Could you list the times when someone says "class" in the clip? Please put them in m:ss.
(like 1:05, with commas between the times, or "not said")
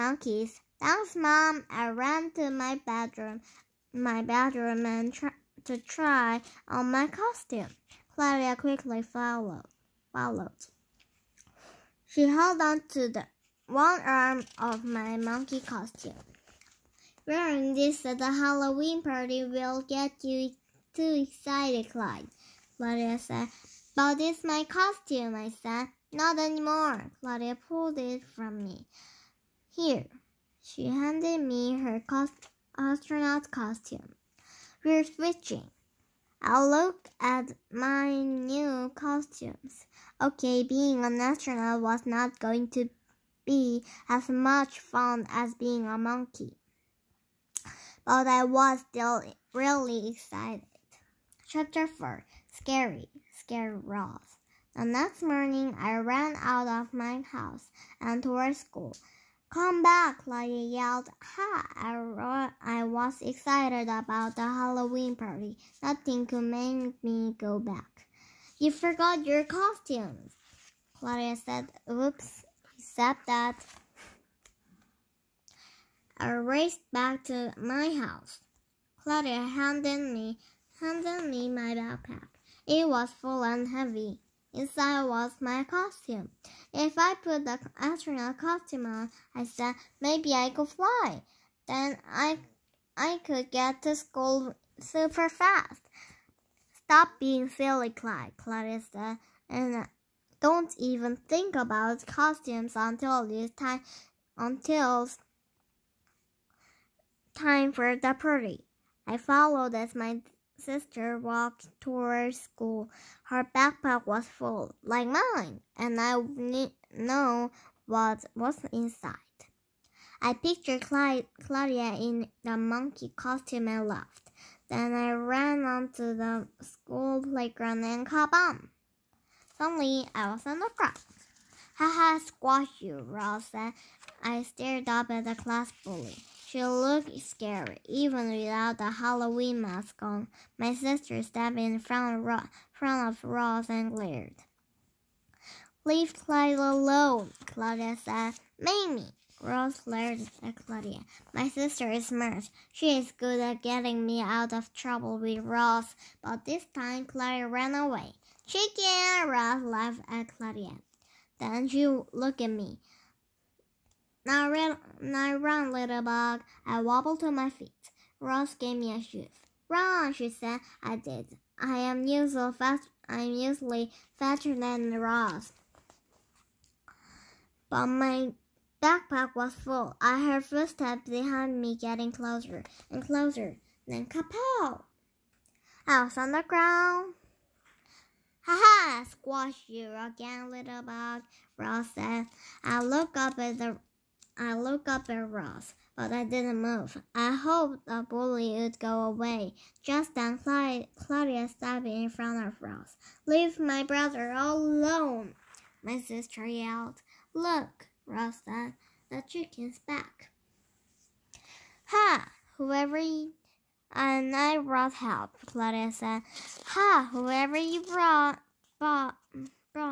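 2:15.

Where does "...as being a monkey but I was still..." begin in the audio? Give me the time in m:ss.
0:45.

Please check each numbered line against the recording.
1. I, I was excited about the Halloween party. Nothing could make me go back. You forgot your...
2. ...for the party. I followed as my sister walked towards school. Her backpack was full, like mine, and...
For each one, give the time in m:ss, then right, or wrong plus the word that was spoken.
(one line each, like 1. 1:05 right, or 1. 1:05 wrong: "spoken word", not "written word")
1. 1:01 right
2. 1:47 right.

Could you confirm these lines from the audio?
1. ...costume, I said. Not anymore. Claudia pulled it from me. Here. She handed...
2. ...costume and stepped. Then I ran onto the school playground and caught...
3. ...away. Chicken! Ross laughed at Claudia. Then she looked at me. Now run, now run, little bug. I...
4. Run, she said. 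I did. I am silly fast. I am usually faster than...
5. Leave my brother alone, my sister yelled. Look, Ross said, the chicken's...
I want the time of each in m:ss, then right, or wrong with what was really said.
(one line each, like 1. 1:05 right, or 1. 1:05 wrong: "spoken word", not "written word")
1. 0:24 right
2. 2:03 wrong: "laughed", not "stepped"
3. 2:37 right
4. 2:49 wrong: "usually", not "silly"
5. 3:23 right.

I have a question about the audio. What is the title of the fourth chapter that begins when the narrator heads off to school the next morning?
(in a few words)
Scary, Scary Ross.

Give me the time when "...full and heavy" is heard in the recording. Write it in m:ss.
1:23.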